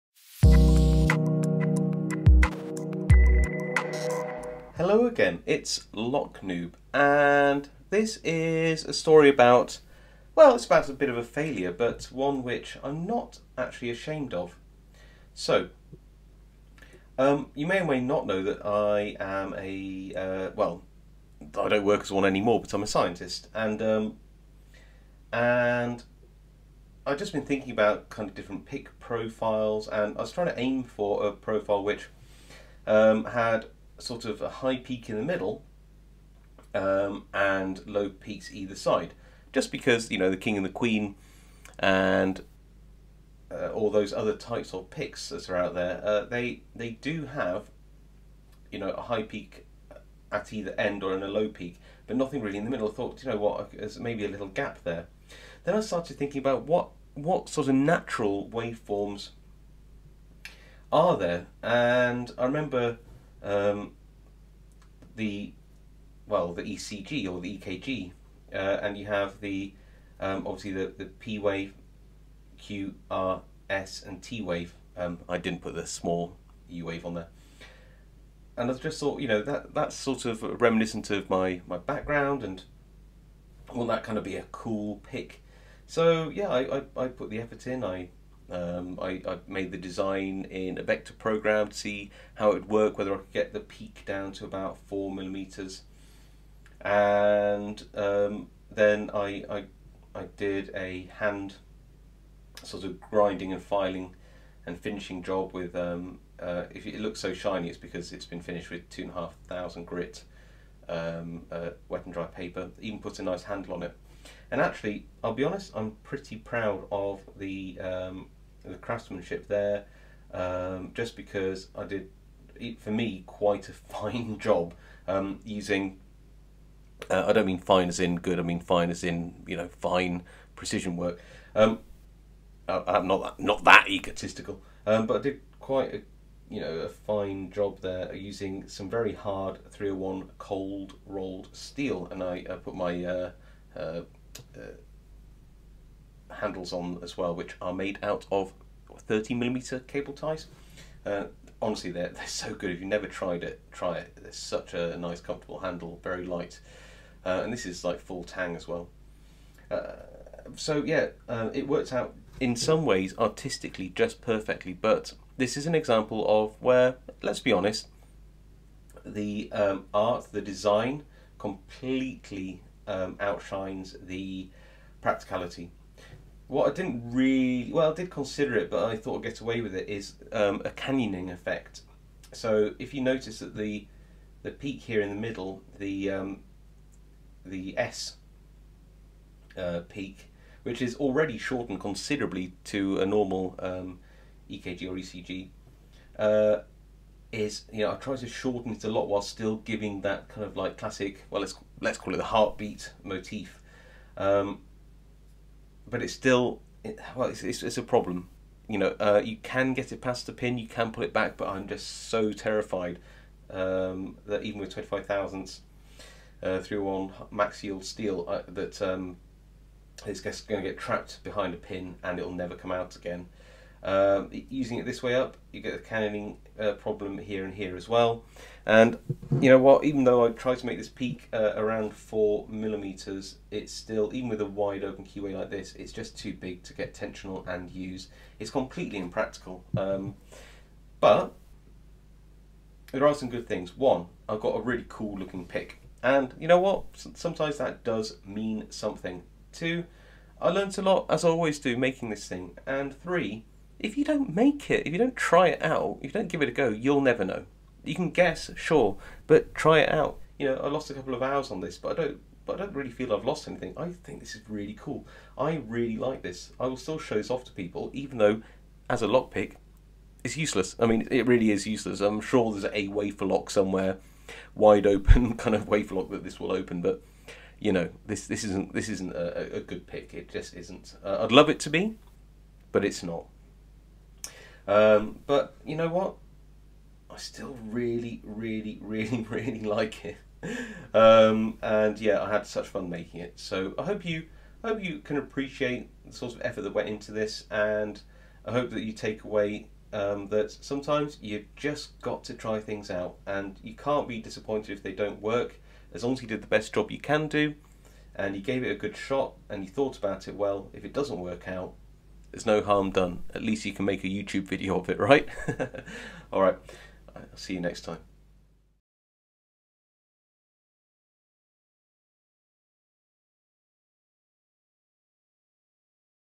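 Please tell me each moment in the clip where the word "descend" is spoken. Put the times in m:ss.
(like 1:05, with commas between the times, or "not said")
not said.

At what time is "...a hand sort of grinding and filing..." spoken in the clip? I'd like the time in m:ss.
1:40.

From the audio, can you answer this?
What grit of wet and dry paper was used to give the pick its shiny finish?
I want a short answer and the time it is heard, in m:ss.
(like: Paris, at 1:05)
2500, at 1:48.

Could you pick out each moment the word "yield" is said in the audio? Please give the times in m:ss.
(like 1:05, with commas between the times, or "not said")
3:37.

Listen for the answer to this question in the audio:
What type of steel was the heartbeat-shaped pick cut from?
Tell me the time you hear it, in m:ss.
2:19.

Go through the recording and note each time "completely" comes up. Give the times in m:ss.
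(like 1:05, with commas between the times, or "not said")
2:51, 3:58.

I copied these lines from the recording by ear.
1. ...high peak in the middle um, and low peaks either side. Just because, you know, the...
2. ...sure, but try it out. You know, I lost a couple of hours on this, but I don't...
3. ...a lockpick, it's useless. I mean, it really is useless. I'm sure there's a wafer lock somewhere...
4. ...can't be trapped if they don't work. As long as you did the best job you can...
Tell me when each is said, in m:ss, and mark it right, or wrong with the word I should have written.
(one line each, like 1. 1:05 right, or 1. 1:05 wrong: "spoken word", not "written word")
1. 0:34 right
2. 4:18 right
3. 4:29 right
4. 5:03 wrong: "disappointed", not "trapped".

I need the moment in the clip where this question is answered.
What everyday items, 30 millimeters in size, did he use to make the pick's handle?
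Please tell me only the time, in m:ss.
2:29.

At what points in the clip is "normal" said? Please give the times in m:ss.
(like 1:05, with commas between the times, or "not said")
3:13.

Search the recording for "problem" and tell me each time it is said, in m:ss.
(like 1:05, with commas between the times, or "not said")
3:27, 3:46.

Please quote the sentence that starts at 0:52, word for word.
I thought, you know what, there's maybe a little gap there.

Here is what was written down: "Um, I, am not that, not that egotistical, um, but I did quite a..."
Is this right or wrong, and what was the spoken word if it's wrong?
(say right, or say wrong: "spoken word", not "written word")
right.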